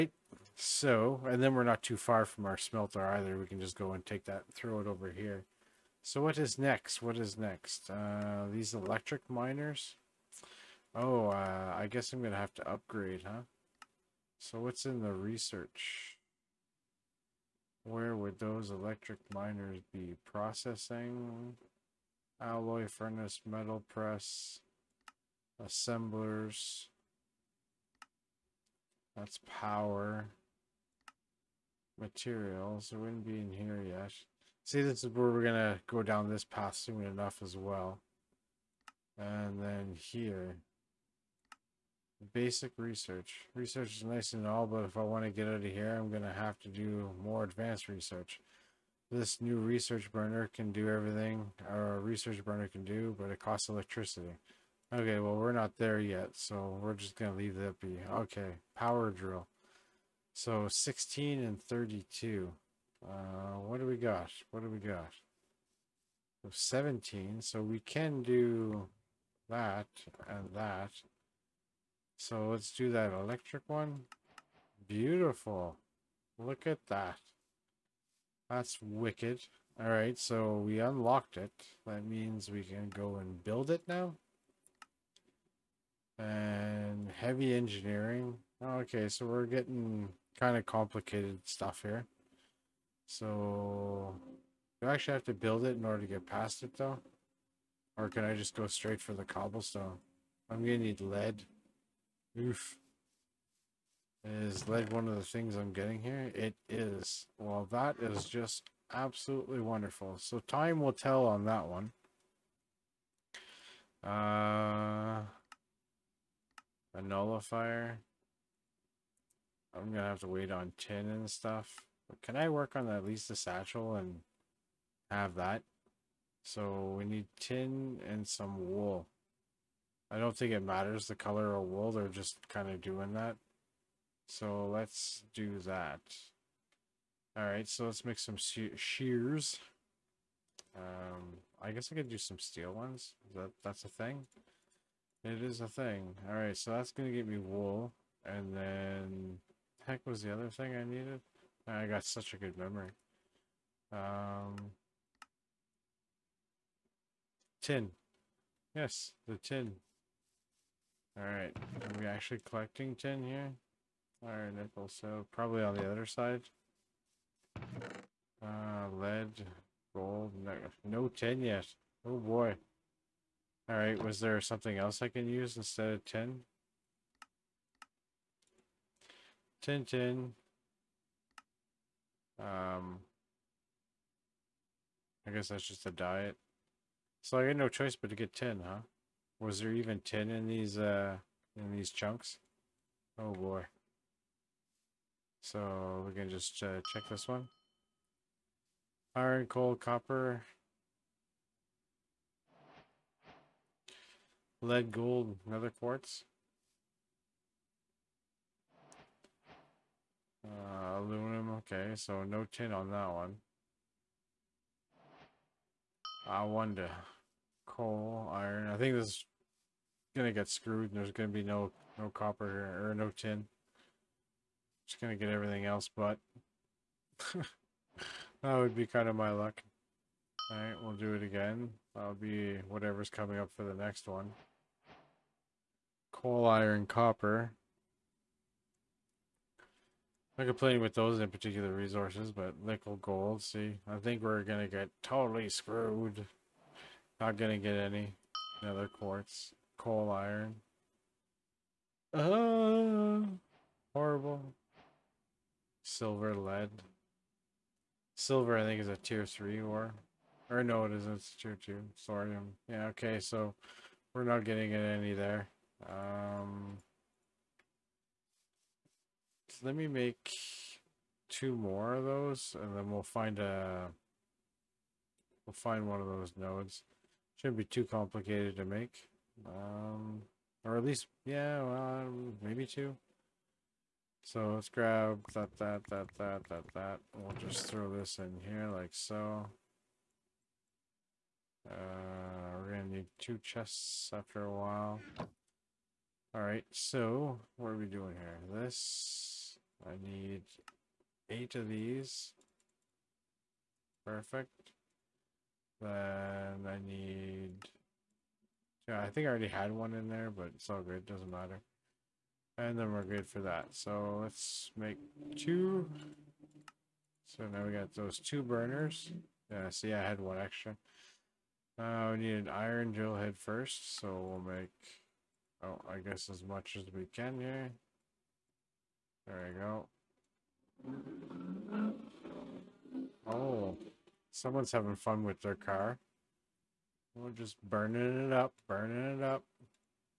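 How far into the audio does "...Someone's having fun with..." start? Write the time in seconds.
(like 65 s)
334 s.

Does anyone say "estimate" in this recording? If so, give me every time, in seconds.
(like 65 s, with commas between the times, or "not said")
not said.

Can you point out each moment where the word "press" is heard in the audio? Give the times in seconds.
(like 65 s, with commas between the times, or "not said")
23 s.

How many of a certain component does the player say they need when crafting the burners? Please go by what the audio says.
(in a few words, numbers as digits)
8.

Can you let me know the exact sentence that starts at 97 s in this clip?
Or can I just go straight for the cobblestone?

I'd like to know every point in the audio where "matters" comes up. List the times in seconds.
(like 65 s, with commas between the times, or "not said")
130 s, 311 s.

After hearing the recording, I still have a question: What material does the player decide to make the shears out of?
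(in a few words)
steel.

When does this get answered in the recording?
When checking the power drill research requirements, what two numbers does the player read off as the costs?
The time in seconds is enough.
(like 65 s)
60 s.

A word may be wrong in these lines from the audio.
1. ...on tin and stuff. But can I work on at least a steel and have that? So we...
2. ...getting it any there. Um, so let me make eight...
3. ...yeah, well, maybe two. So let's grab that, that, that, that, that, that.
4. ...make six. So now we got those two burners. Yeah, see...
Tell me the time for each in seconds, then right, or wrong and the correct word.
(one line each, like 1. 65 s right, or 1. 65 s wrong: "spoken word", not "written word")
1. 120 s wrong: "satchel", not "steel"
2. 264 s wrong: "two", not "eight"
3. 281 s right
4. 314 s wrong: "two", not "six".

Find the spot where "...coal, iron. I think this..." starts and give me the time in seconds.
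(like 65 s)
217 s.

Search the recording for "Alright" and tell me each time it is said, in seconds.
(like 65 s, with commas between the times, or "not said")
161 s, 173 s, 230 s, 296 s.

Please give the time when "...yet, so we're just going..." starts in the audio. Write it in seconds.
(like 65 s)
55 s.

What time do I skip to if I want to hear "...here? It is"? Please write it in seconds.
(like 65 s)
106 s.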